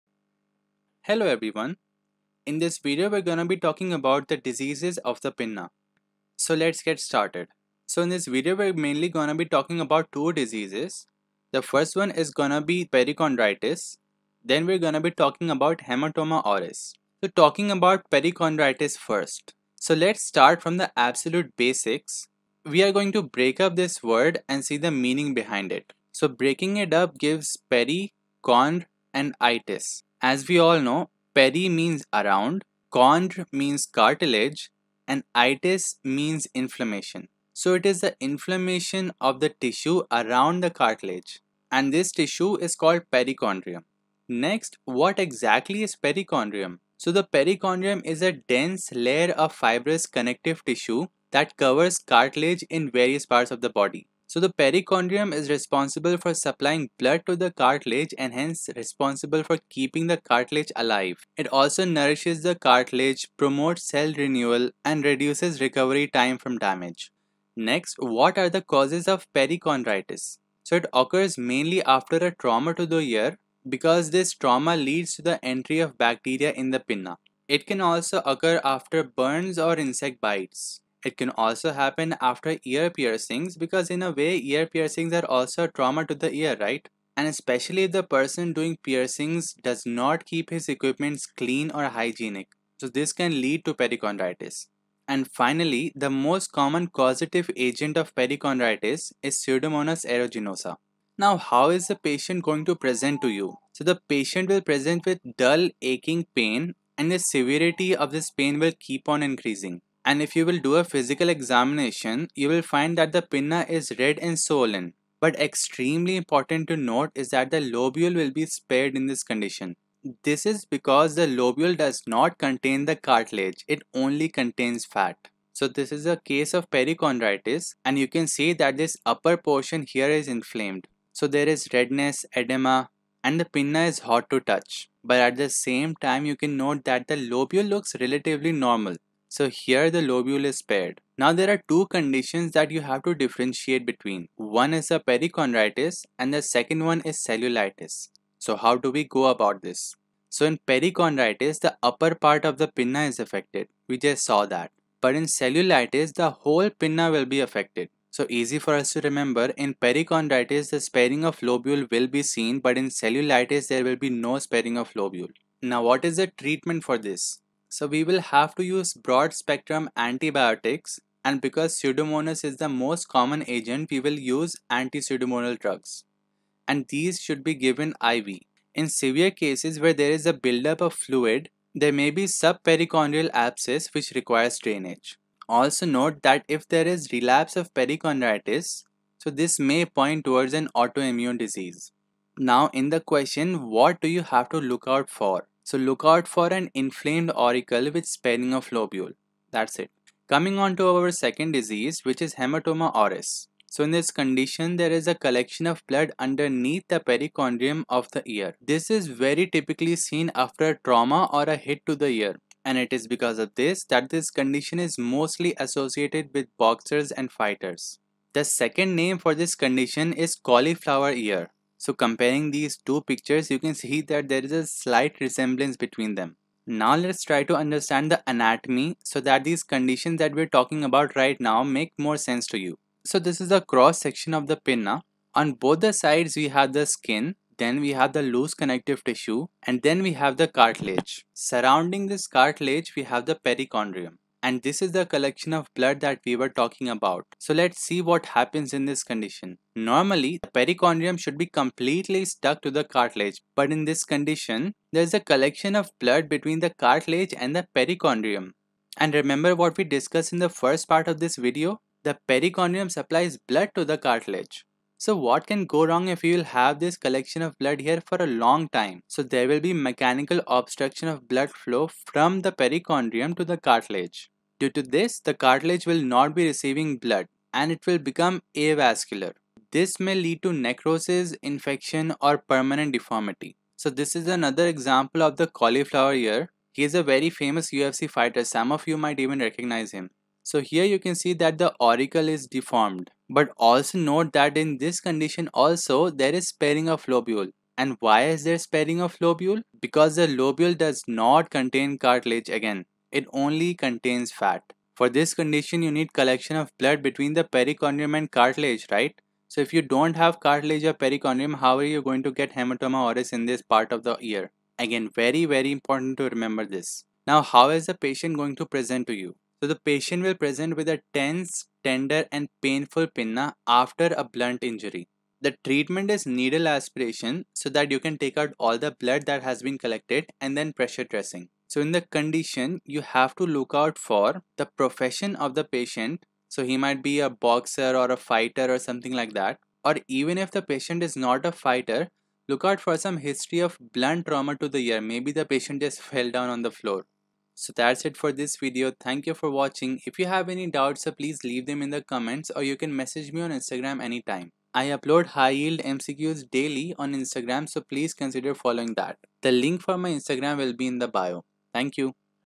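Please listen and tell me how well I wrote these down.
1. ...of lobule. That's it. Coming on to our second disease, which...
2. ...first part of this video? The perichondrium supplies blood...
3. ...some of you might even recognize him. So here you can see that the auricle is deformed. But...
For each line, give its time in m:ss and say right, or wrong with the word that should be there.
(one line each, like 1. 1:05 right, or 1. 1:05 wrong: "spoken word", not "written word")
1. 3:18 right
2. 4:20 right
3. 4:48 right.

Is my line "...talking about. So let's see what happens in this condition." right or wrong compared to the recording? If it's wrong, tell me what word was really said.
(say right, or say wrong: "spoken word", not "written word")
right.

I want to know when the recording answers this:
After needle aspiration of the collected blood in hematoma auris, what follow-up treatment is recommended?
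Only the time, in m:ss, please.
5:30.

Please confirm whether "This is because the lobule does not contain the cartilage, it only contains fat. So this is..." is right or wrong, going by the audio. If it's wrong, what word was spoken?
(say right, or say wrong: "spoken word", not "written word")
right.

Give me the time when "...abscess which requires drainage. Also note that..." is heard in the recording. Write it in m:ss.
3:03.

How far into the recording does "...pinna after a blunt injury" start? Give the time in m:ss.
5:23.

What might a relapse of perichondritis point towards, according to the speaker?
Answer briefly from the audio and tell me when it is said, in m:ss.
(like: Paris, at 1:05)
An autoimmune disease, at 3:10.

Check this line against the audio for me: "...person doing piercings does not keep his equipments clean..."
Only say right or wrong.
right.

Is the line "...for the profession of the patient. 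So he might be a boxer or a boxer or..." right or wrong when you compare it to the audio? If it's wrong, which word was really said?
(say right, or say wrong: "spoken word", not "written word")
wrong: "fighter", not "boxer".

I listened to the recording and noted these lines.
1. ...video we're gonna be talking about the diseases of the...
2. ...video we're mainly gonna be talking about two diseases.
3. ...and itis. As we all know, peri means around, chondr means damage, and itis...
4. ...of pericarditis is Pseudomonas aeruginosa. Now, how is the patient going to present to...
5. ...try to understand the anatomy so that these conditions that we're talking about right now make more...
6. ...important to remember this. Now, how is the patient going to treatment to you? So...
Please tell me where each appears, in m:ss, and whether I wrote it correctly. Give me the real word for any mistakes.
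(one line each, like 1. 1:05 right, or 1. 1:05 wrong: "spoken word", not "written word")
1. 0:02 right
2. 0:08 right
3. 0:29 wrong: "cartilage", not "damage"
4. 1:37 right
5. 3:47 right
6. 5:15 wrong: "present", not "treatment".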